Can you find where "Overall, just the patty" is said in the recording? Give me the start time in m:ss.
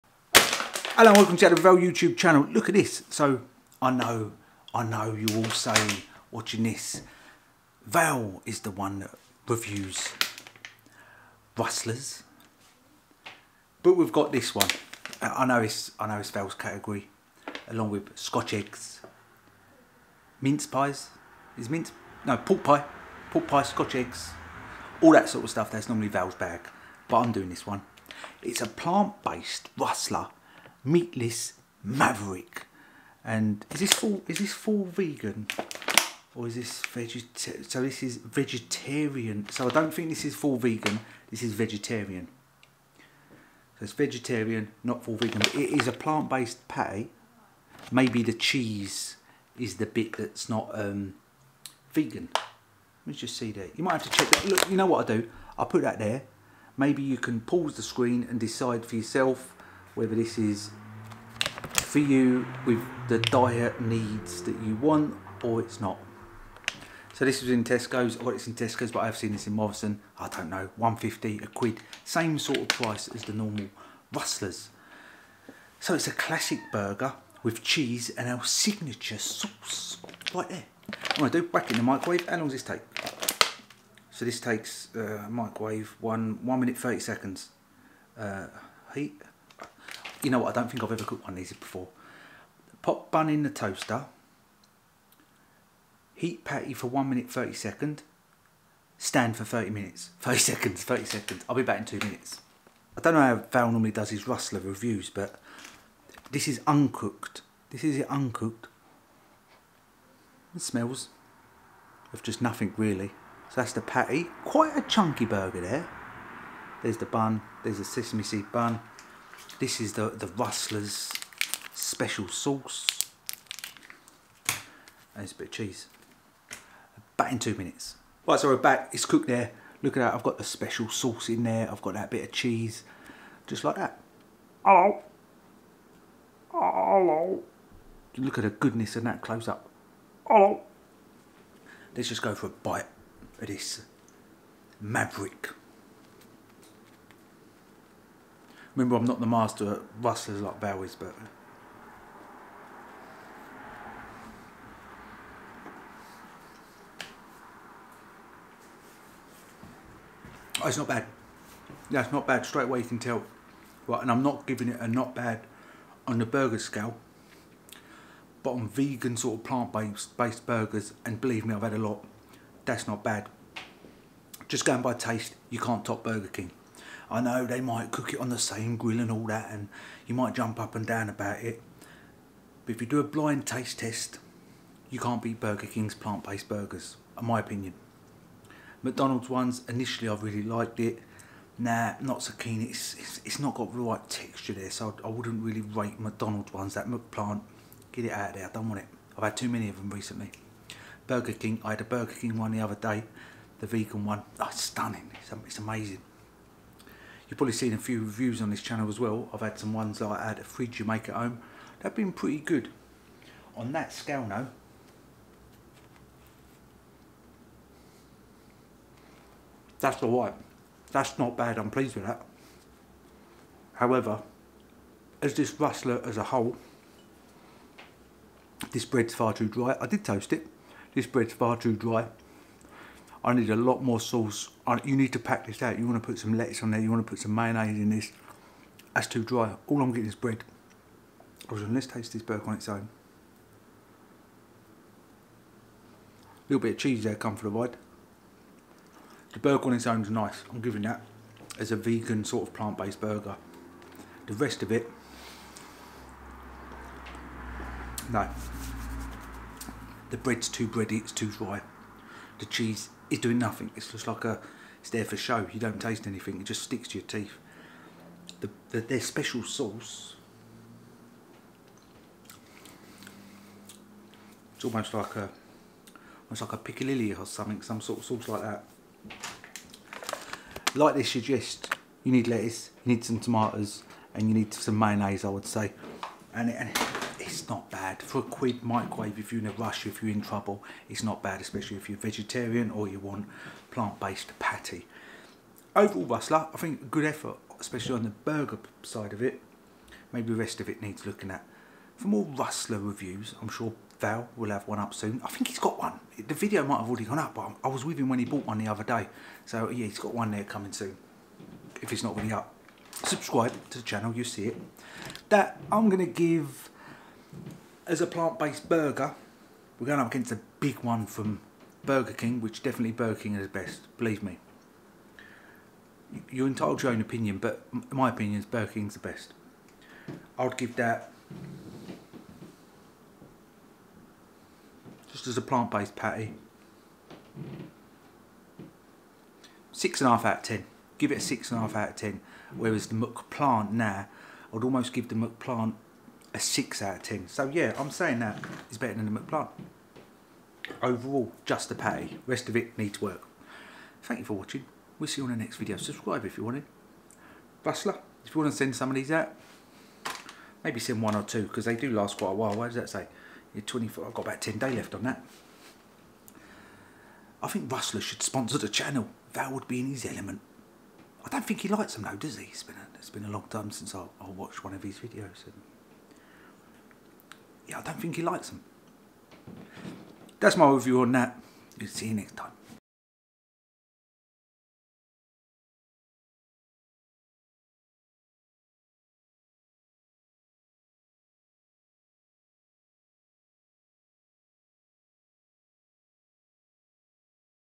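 5:50.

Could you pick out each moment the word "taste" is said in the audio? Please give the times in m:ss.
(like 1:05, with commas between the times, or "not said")
2:54, 3:03, 4:01, 4:25.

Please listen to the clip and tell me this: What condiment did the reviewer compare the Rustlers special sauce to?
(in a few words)
piccalilli.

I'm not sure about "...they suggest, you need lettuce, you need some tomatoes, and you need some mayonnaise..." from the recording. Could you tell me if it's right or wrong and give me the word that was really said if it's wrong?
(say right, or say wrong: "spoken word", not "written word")
right.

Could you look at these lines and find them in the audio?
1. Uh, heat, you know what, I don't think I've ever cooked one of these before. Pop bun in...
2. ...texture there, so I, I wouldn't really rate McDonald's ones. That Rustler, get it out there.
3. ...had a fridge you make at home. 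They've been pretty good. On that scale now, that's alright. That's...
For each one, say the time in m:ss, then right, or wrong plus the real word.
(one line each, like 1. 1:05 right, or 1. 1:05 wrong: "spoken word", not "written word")
1. 1:28 right
2. 3:14 wrong: "McPlant", not "Rustler"
3. 3:30 right.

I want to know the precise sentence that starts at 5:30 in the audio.
I would give that, just as a plant-based patty, 6.5 out of 10.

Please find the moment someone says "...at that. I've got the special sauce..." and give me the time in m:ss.
2:09.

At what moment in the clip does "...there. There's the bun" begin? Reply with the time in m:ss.
1:55.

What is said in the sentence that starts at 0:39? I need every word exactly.
So I don't think this is full vegan.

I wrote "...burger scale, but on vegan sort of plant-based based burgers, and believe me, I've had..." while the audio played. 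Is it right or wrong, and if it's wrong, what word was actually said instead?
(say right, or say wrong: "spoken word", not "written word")
right.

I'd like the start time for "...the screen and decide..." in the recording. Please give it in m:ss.
0:57.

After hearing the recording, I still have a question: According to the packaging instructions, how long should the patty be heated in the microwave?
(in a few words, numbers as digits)
1 minute 30 seconds.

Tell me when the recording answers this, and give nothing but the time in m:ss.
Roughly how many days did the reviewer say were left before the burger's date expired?
6:04.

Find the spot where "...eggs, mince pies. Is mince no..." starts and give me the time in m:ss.
0:18.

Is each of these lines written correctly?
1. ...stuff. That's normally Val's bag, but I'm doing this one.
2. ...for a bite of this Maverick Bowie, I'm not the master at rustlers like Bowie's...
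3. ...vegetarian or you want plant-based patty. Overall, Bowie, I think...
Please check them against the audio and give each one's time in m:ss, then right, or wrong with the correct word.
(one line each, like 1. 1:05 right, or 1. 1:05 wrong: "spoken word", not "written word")
1. 0:25 right
2. 2:22 wrong: "Remember", not "Bowie"
3. 4:51 wrong: "Rustler", not "Bowie".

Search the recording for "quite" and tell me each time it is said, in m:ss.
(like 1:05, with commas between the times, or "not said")
1:54, 6:02.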